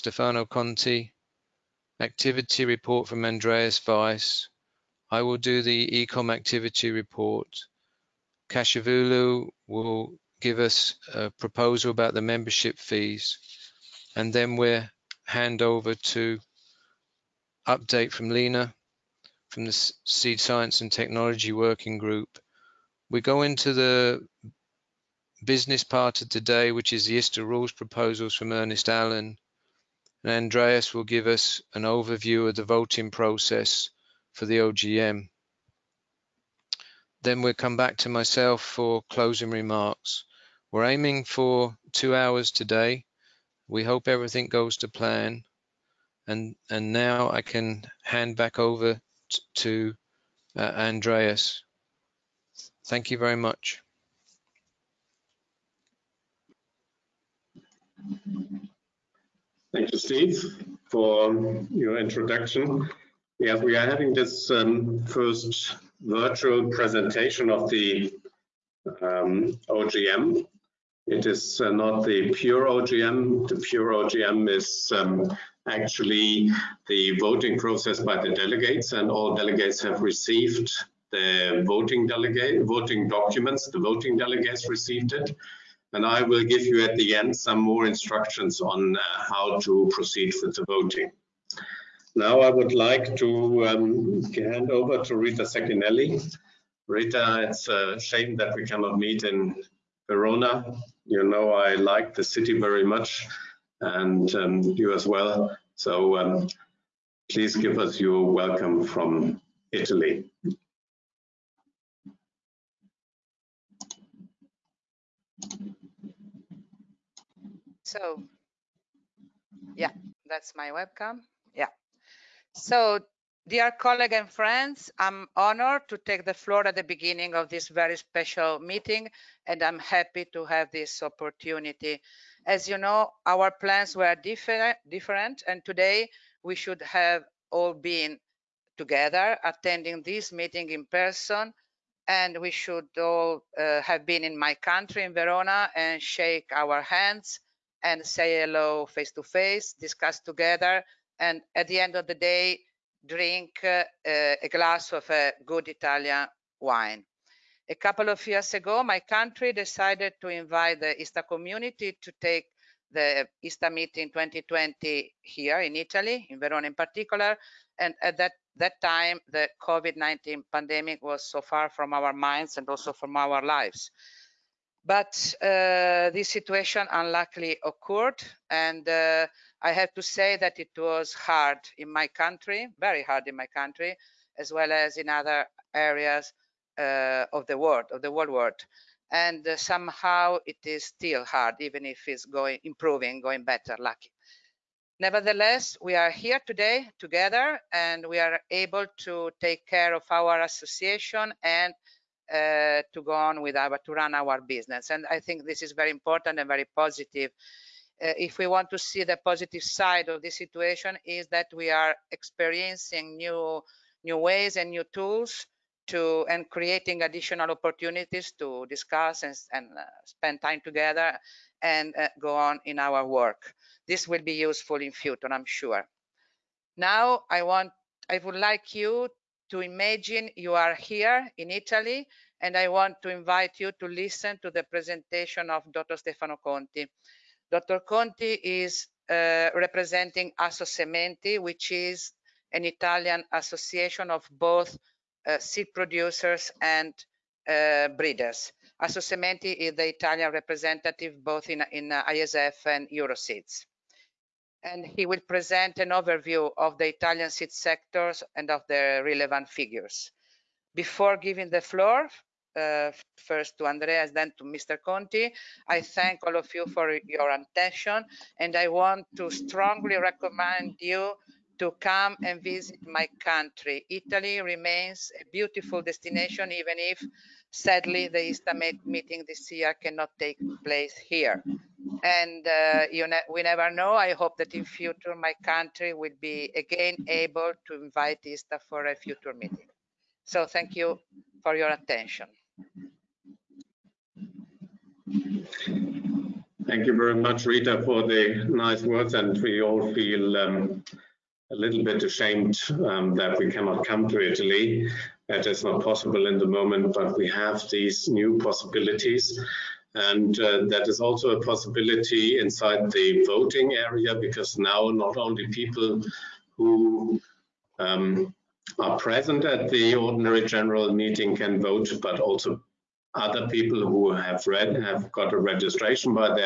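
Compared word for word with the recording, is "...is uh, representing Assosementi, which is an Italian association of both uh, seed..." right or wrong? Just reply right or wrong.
right.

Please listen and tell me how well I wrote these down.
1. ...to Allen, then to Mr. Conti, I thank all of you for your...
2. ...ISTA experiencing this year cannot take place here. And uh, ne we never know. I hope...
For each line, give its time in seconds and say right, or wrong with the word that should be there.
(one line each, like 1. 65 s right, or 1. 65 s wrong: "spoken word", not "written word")
1. 263 s wrong: "Andreas", not "Allen"
2. 278 s wrong: "meeting", not "experiencing".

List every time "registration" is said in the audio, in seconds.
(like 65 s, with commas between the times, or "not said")
325 s.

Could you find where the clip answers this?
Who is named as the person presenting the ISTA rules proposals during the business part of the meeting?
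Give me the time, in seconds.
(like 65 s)
28 s.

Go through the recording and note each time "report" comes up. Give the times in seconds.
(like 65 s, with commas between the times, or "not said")
2 s, 6 s.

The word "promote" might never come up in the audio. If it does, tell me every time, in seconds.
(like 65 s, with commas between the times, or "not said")
not said.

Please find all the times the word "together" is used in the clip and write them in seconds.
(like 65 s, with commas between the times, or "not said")
138 s, 150 s, 196 s, 220 s.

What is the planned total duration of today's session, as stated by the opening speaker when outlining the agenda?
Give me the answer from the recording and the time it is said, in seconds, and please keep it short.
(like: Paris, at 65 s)
2 hours, at 41 s.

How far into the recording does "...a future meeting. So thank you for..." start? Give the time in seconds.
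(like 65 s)
288 s.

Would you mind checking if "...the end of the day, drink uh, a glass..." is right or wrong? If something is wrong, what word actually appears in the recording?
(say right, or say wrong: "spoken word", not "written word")
right.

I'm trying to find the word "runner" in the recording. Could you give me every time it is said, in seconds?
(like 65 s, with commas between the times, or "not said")
not said.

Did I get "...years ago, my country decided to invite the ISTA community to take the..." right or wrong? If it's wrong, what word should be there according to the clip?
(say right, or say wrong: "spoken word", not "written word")
right.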